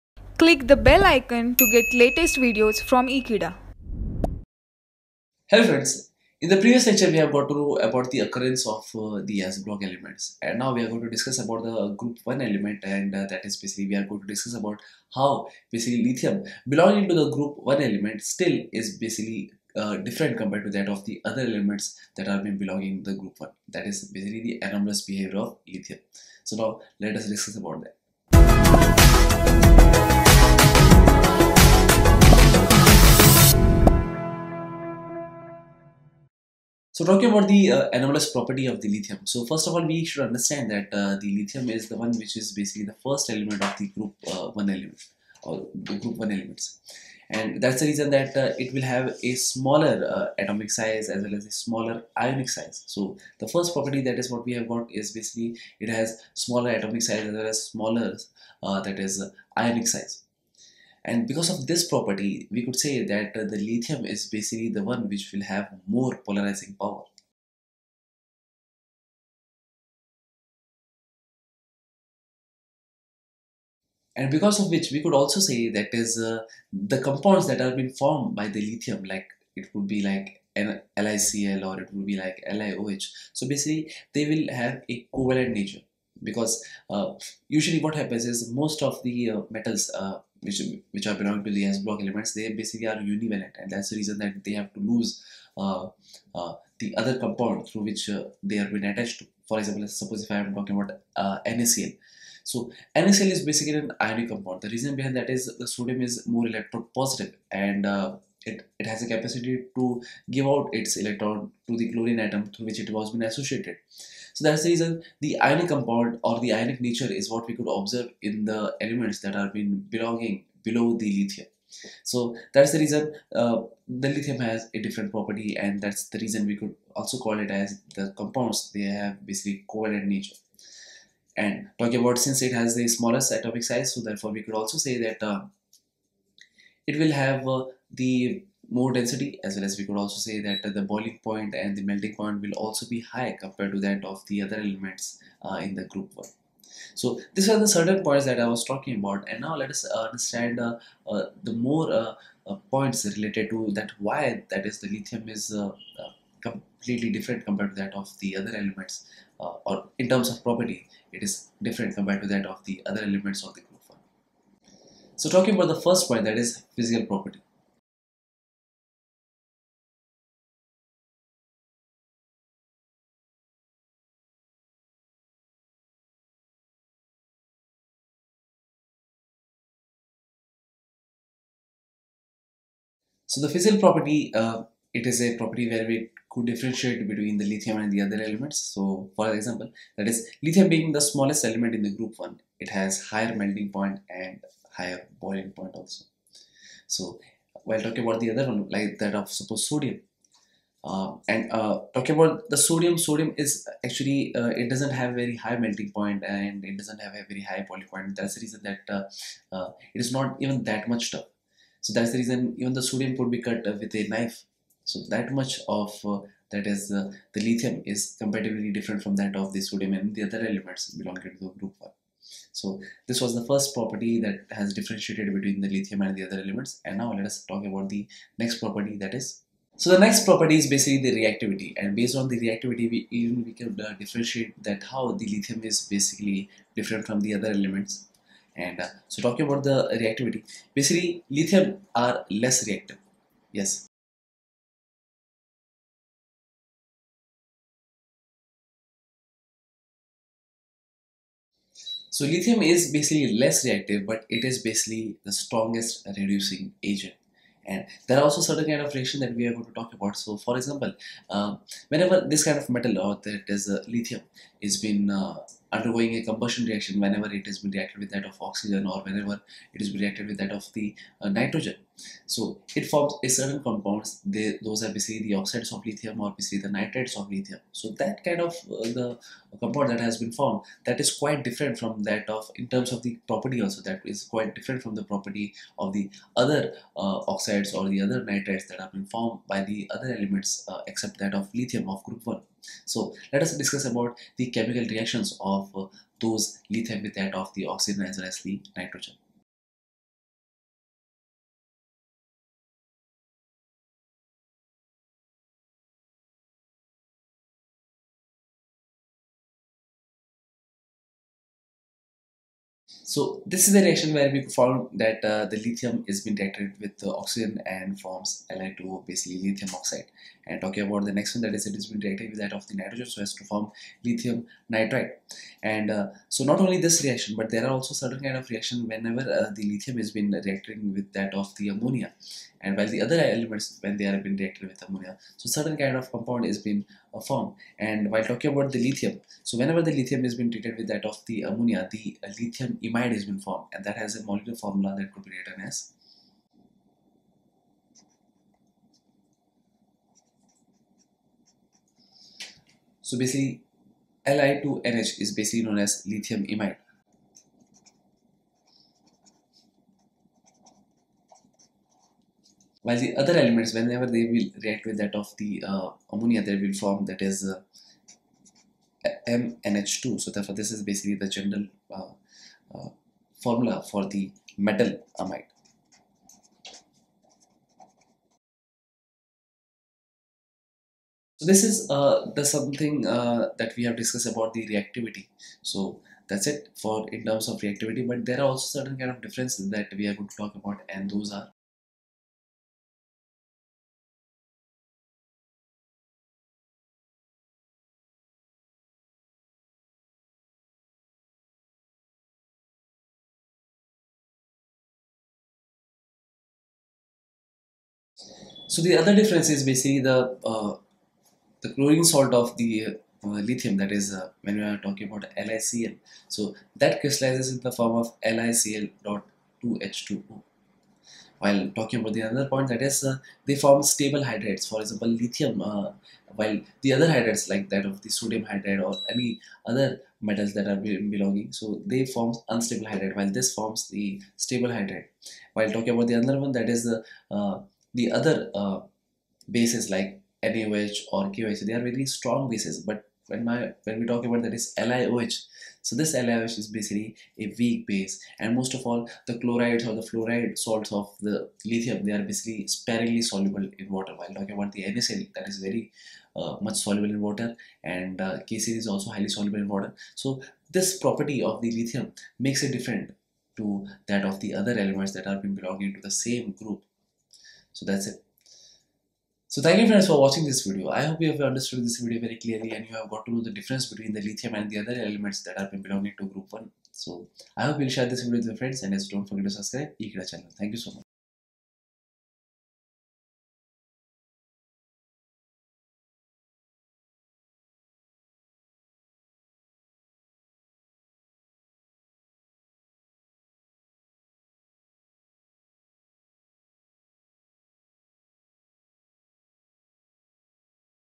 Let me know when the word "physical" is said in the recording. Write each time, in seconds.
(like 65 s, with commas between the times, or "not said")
166 s, 183 s.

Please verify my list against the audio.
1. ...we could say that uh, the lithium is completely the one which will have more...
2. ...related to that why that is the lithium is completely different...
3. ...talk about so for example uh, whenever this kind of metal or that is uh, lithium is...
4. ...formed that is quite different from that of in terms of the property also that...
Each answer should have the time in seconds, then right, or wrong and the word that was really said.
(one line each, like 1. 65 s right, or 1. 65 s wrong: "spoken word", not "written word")
1. 62 s wrong: "basically", not "completely"
2. 153 s right
3. 259 s right
4. 280 s right.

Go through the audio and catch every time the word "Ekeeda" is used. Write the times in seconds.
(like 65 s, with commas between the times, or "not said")
3 s, 480 s.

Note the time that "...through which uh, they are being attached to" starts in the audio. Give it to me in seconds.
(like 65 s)
97 s.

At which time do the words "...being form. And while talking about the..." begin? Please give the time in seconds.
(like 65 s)
336 s.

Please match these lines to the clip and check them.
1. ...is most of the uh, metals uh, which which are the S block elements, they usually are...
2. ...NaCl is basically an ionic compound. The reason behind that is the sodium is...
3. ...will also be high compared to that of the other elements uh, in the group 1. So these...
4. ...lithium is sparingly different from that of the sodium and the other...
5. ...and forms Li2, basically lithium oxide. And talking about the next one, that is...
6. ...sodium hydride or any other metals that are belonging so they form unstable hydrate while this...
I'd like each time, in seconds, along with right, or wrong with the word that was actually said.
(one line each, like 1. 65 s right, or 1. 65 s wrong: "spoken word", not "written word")
1. 88 s wrong: "basically", not "usually"
2. 102 s right
3. 142 s right
4. 217 s wrong: "comparatively", not "sparingly"
5. 317 s right
6. 428 s right.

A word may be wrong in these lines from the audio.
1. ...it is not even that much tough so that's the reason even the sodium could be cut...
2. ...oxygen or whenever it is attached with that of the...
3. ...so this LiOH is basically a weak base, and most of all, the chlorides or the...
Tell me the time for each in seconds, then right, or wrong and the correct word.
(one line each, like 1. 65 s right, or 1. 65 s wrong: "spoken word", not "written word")
1. 209 s right
2. 268 s wrong: "reacted", not "attached"
3. 445 s right.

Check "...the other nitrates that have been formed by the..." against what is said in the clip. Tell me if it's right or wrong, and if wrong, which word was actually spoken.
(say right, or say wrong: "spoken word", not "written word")
right.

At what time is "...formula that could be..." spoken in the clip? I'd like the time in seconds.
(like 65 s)
344 s.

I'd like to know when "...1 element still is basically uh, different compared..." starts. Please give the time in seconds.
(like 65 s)
17 s.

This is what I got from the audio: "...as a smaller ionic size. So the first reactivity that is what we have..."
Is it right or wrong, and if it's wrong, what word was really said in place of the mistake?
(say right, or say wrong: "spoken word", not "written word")
wrong: "property", not "reactivity".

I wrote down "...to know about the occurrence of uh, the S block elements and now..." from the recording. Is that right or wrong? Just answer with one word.
right.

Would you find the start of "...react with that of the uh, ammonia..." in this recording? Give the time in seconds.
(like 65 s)
364 s.